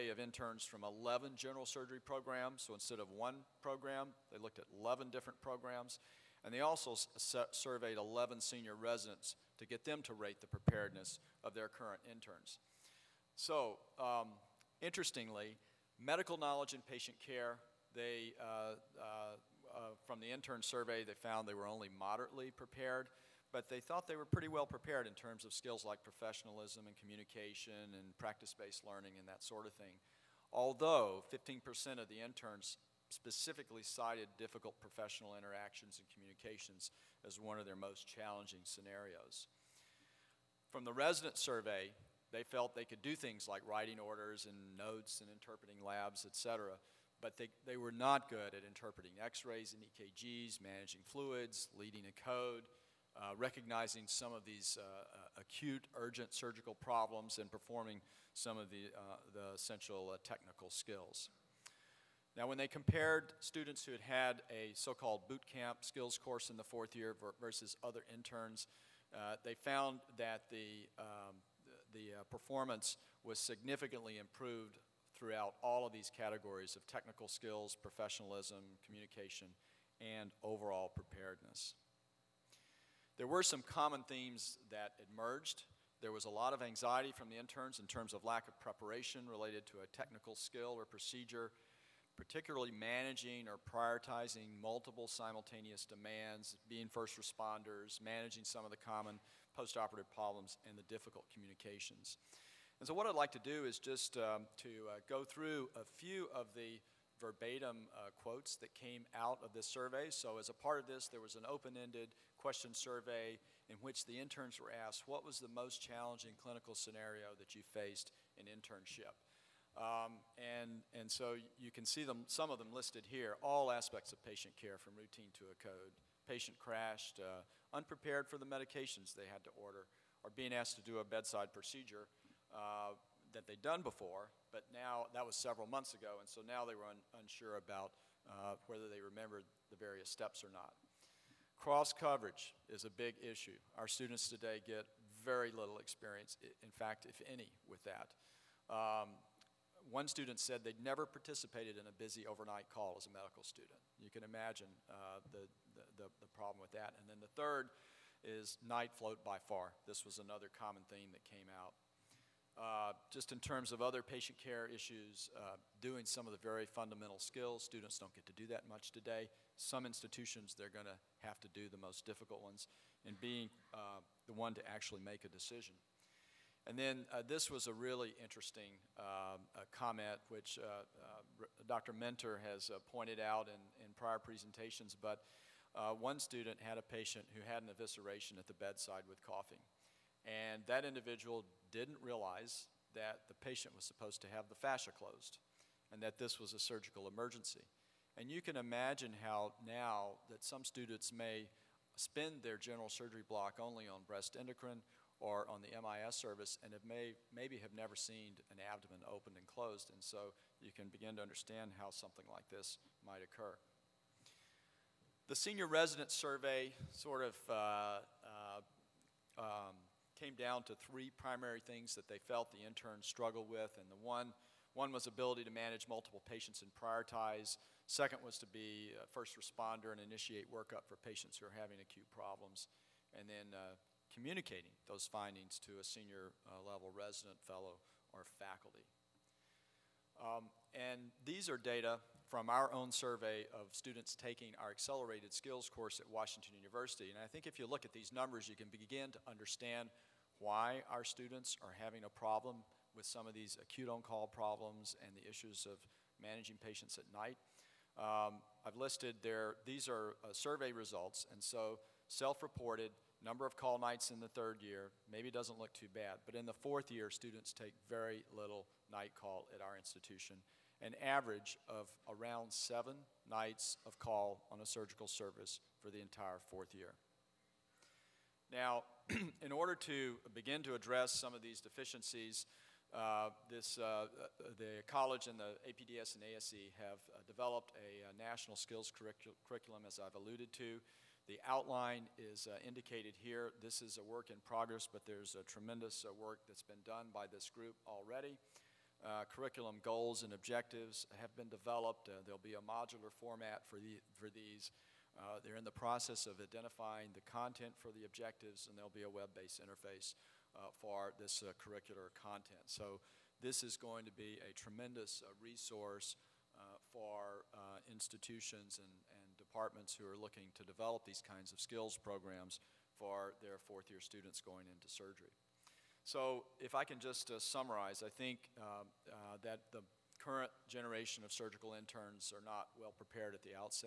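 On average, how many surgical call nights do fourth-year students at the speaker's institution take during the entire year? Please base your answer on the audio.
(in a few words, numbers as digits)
7.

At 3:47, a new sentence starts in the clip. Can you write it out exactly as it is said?
Second was to be a first responder and initiate workup for patients who are having acute problems.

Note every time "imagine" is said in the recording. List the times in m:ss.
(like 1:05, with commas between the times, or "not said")
2:34, 3:18.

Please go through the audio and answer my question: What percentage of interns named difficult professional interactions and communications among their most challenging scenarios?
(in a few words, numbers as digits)
15%.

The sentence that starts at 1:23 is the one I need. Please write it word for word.
There were some common themes that emerged.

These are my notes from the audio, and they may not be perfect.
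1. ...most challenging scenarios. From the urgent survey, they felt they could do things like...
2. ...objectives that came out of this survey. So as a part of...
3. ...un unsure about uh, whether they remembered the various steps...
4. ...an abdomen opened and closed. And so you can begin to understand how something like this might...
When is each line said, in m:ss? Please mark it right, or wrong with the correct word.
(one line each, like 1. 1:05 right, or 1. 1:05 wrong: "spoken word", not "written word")
1. 0:37 wrong: "resident", not "urgent"
2. 1:48 wrong: "quotes", not "objectives"
3. 2:16 right
4. 3:28 right.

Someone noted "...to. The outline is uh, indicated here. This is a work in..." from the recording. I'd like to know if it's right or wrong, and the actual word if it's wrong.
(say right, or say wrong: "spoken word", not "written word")
right.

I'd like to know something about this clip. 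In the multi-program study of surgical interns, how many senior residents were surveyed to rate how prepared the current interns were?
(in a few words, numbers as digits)
11.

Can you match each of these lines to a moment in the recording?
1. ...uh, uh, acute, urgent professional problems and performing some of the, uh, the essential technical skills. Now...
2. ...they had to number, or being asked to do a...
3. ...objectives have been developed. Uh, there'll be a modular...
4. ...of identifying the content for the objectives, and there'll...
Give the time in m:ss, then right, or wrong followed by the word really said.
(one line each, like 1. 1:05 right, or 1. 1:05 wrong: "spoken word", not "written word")
1. 0:54 wrong: "surgical", not "professional"
2. 2:09 wrong: "order", not "number"
3. 5:00 right
4. 5:06 right.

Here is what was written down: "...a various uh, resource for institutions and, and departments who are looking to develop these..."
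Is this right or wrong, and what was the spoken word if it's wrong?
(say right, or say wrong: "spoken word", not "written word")
wrong: "tremendous", not "various".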